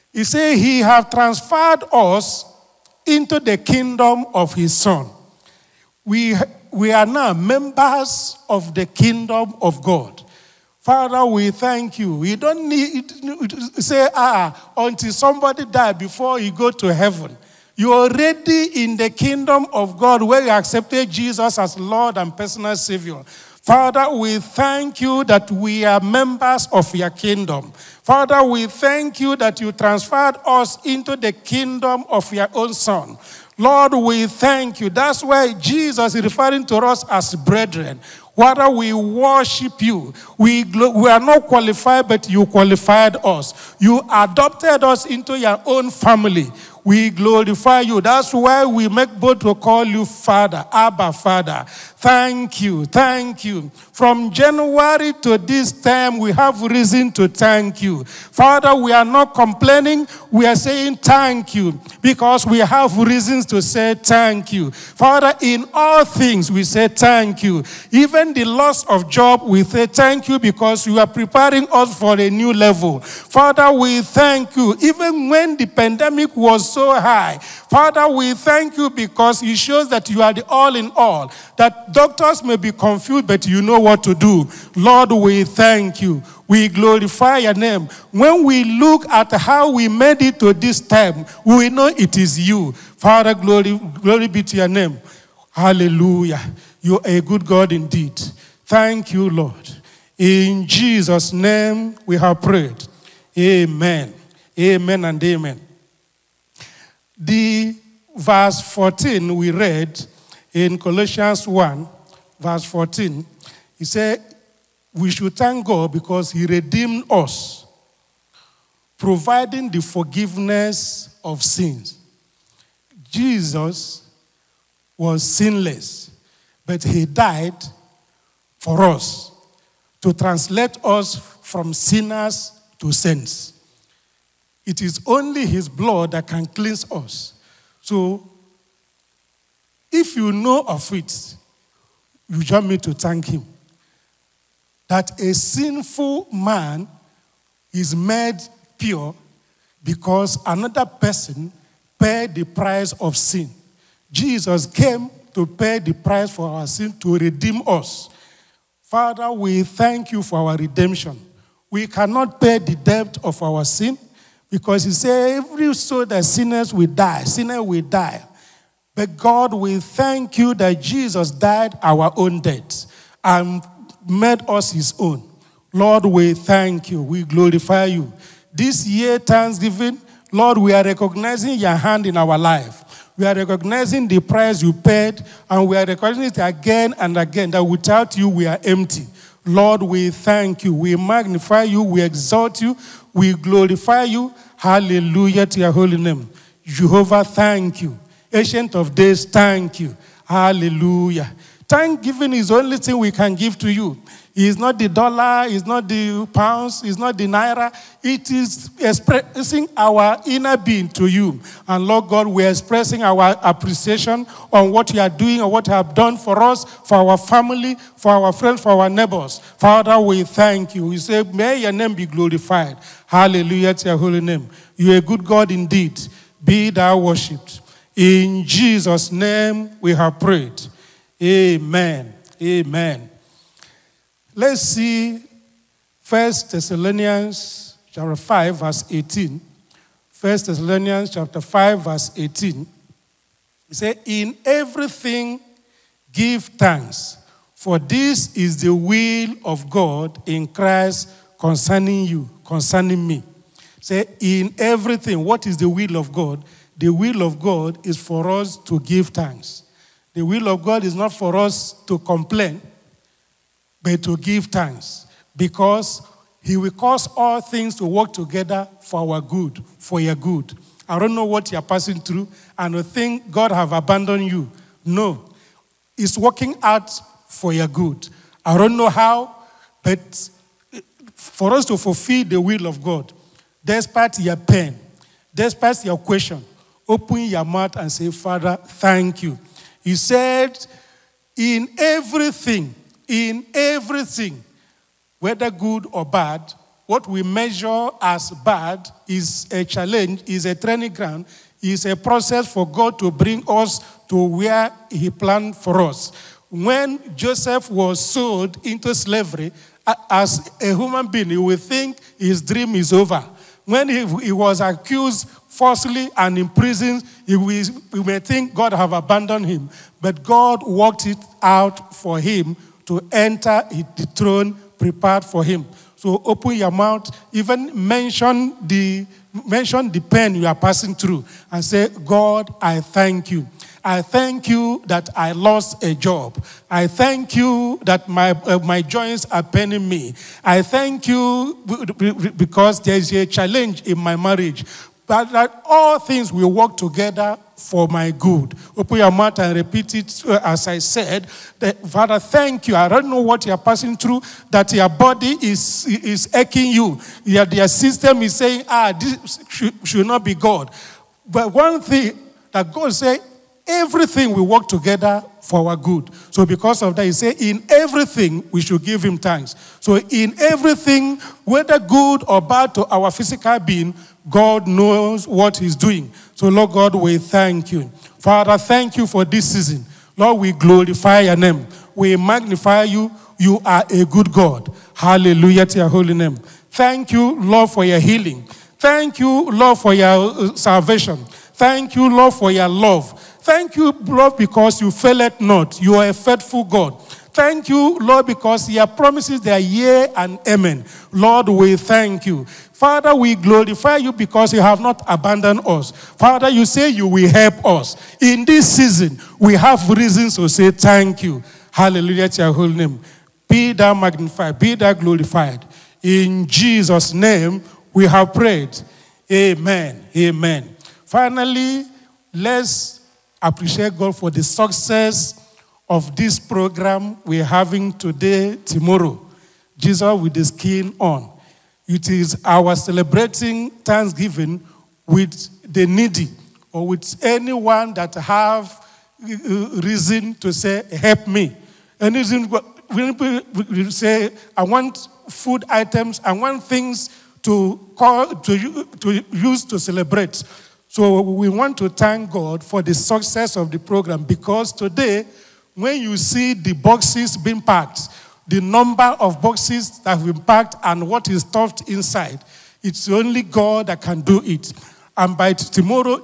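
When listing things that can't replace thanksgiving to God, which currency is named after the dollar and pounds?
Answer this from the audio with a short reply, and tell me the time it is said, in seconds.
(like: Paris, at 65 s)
naira, at 207 s.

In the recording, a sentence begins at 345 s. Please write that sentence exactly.
But that all things will work together for my good.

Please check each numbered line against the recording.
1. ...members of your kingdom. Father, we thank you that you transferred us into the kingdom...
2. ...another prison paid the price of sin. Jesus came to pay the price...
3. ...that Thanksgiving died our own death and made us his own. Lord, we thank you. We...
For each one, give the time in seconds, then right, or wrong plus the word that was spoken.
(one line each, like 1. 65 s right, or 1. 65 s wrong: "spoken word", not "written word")
1. 26 s right
2. 150 s wrong: "person", not "prison"
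3. 170 s wrong: "Jesus", not "Thanksgiving".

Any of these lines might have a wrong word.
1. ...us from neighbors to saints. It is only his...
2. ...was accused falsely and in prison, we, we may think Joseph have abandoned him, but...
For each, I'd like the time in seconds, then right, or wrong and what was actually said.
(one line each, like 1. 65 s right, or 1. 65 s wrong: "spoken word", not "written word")
1. 130 s wrong: "sinners", not "neighbors"
2. 314 s wrong: "God", not "Joseph".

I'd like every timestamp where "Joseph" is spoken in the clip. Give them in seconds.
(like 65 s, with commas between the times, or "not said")
307 s.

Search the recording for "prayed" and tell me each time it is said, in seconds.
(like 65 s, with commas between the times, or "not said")
102 s, 230 s, 418 s.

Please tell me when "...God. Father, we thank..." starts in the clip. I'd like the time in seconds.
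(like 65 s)
9 s.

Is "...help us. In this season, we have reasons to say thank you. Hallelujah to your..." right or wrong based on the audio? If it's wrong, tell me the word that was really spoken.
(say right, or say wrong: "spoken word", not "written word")
right.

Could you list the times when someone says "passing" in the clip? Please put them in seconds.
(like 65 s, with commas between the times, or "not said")
271 s, 330 s, 353 s.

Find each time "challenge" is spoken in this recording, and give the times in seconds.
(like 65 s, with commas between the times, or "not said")
299 s, 343 s.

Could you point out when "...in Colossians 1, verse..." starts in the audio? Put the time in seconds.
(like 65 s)
110 s.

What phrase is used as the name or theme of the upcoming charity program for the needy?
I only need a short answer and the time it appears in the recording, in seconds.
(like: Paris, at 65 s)
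Jesus with the skin on, at 429 s.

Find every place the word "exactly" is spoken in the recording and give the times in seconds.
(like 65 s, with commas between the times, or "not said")
not said.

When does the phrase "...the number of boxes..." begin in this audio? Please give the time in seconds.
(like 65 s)
458 s.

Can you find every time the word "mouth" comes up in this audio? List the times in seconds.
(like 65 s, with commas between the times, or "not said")
287 s, 326 s, 349 s.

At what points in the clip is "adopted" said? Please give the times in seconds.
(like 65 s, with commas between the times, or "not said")
44 s.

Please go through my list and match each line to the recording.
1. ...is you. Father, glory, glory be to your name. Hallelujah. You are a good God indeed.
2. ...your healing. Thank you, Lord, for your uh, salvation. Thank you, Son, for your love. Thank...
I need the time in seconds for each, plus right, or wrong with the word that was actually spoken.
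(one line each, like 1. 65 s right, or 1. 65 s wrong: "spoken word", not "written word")
1. 92 s right
2. 387 s wrong: "Lord", not "Son".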